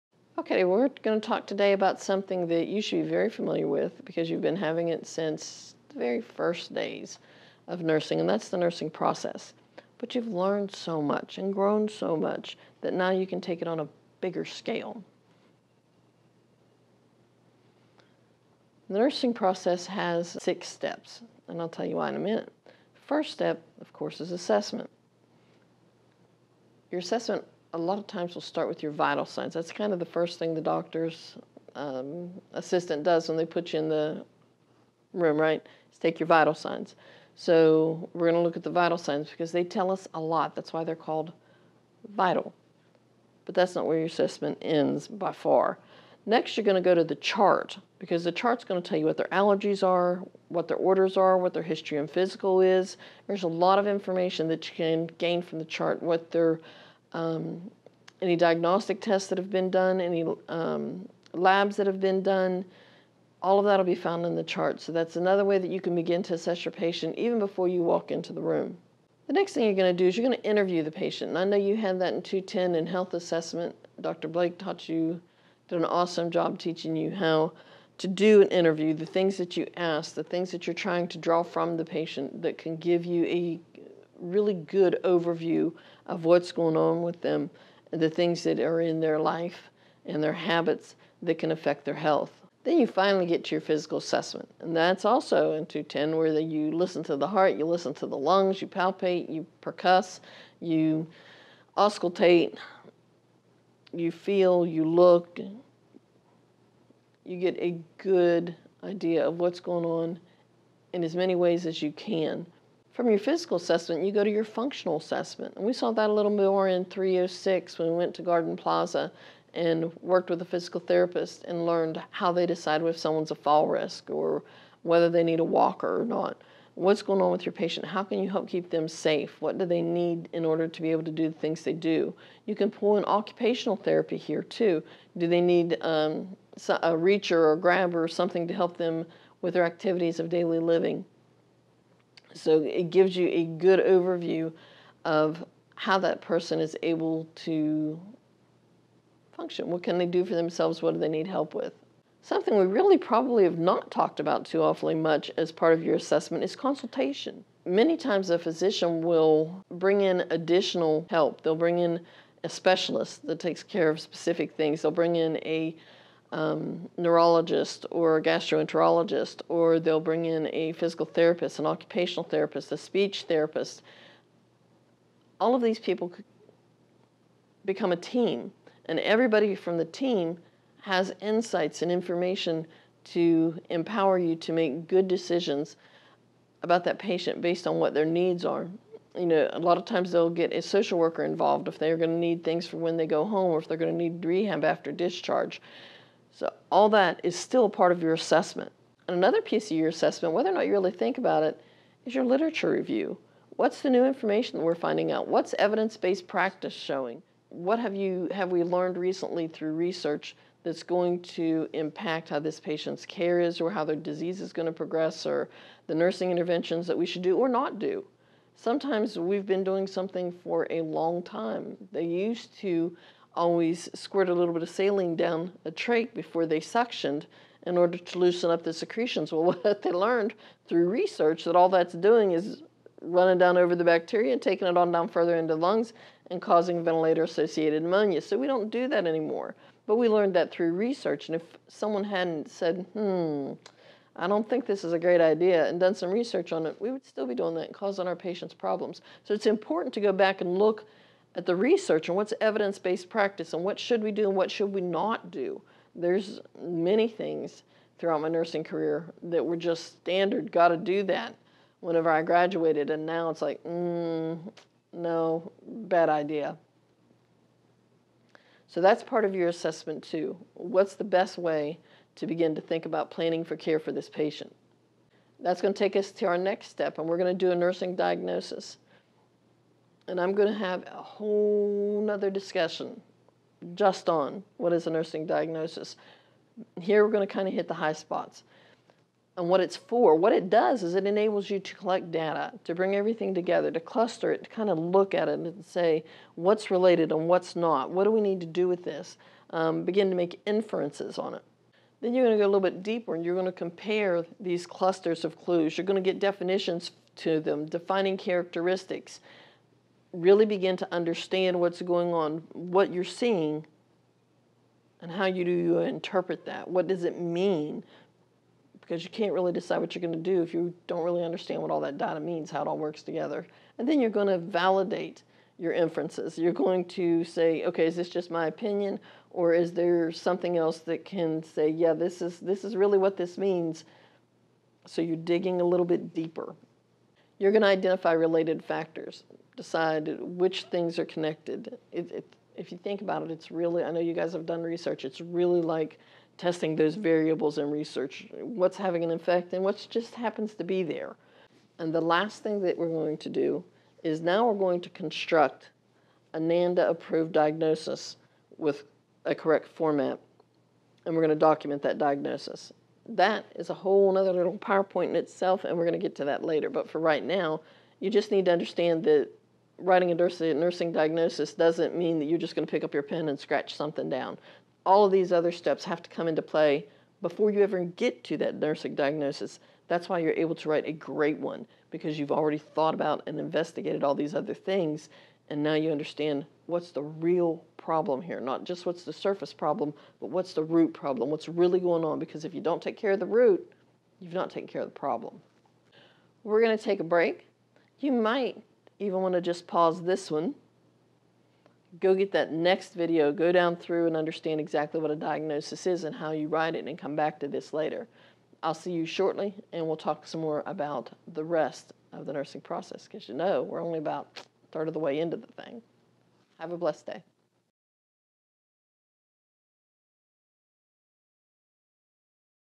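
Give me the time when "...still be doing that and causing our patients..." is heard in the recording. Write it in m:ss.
4:07.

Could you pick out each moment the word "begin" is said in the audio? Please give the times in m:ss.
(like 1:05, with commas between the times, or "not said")
1:05, 4:32, 4:59, 5:10.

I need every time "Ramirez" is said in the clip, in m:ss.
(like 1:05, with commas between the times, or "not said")
not said.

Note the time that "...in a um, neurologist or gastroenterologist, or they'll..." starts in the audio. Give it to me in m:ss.
2:45.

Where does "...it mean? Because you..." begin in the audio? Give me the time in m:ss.
5:17.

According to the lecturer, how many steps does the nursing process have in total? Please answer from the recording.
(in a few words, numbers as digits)
6.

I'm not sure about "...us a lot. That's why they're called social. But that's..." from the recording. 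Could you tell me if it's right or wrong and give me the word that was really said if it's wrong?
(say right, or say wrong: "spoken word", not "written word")
wrong: "vital", not "social".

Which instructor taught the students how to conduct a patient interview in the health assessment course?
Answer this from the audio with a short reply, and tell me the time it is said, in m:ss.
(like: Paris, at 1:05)
Dr. Blake, at 1:14.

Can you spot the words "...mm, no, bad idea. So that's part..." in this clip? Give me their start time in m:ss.
4:23.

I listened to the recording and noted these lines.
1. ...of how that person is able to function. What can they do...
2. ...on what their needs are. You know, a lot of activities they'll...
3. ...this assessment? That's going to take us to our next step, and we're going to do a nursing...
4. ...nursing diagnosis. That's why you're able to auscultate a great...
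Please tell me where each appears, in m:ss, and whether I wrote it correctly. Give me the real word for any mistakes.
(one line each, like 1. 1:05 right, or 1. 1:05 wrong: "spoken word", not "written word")
1. 2:25 right
2. 3:07 wrong: "times", not "activities"
3. 4:33 wrong: "patient", not "assessment"
4. 6:18 wrong: "write", not "auscultate".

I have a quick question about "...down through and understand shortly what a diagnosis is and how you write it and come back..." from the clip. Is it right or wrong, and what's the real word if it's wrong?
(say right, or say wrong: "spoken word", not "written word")
wrong: "exactly", not "shortly".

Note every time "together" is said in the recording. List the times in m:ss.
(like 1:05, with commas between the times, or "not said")
4:53, 5:23.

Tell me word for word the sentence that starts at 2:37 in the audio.
Many times a physician will bring in additional help.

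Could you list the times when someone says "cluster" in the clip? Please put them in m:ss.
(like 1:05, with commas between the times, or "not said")
4:53, 5:04.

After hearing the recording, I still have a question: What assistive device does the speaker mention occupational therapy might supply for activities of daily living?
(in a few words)
reacher or grabber.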